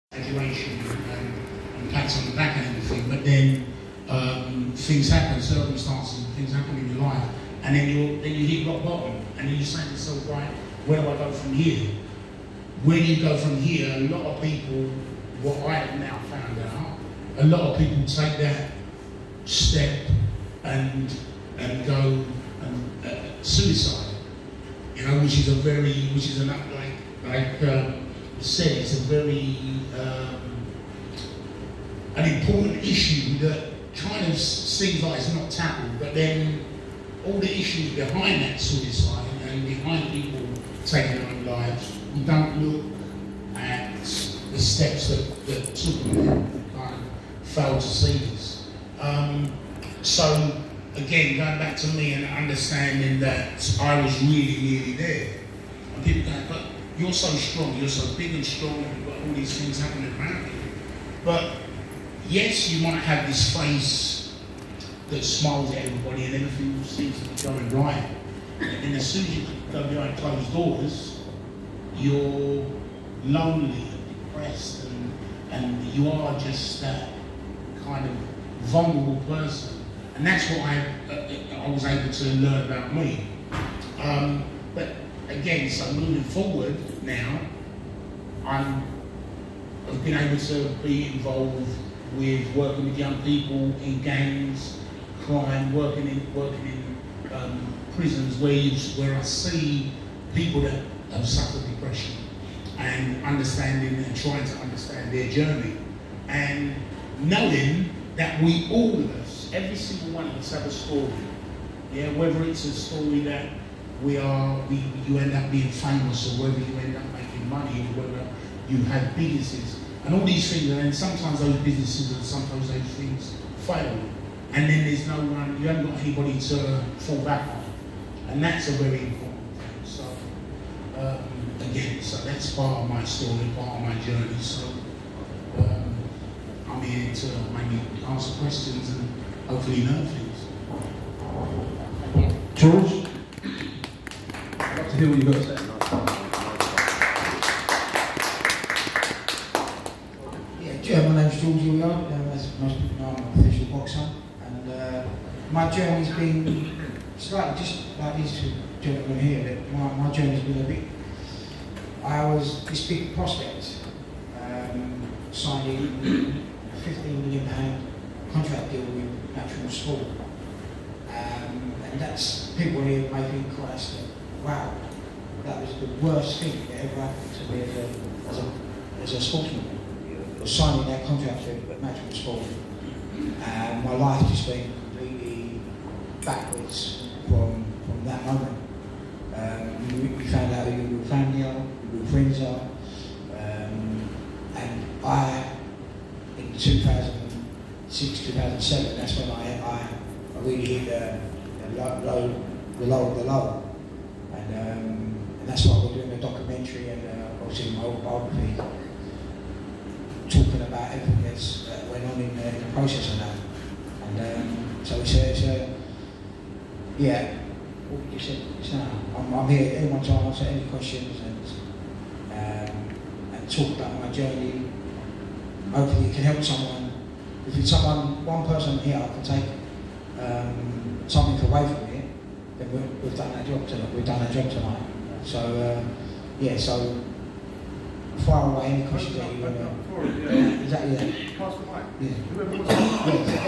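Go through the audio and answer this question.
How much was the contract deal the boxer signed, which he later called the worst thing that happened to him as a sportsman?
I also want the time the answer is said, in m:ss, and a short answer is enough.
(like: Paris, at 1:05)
15 million pounds, at 2:46.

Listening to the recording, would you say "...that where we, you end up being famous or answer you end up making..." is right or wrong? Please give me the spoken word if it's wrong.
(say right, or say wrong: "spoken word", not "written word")
wrong: "whether", not "answer".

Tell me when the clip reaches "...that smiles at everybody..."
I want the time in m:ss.
1:05.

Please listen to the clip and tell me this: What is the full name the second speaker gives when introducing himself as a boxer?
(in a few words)
George Hilliard.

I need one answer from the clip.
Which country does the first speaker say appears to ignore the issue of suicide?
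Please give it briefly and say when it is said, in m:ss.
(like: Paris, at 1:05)
China, at 0:33.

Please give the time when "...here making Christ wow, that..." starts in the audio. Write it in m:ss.
2:52.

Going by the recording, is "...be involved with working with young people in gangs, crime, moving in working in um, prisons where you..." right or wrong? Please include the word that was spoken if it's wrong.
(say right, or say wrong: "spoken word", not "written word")
wrong: "working", not "moving".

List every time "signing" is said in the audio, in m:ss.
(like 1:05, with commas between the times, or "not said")
2:45, 3:00.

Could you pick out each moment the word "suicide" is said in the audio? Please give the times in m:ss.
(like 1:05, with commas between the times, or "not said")
0:23, 0:38.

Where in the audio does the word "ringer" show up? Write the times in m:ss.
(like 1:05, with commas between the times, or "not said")
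not said.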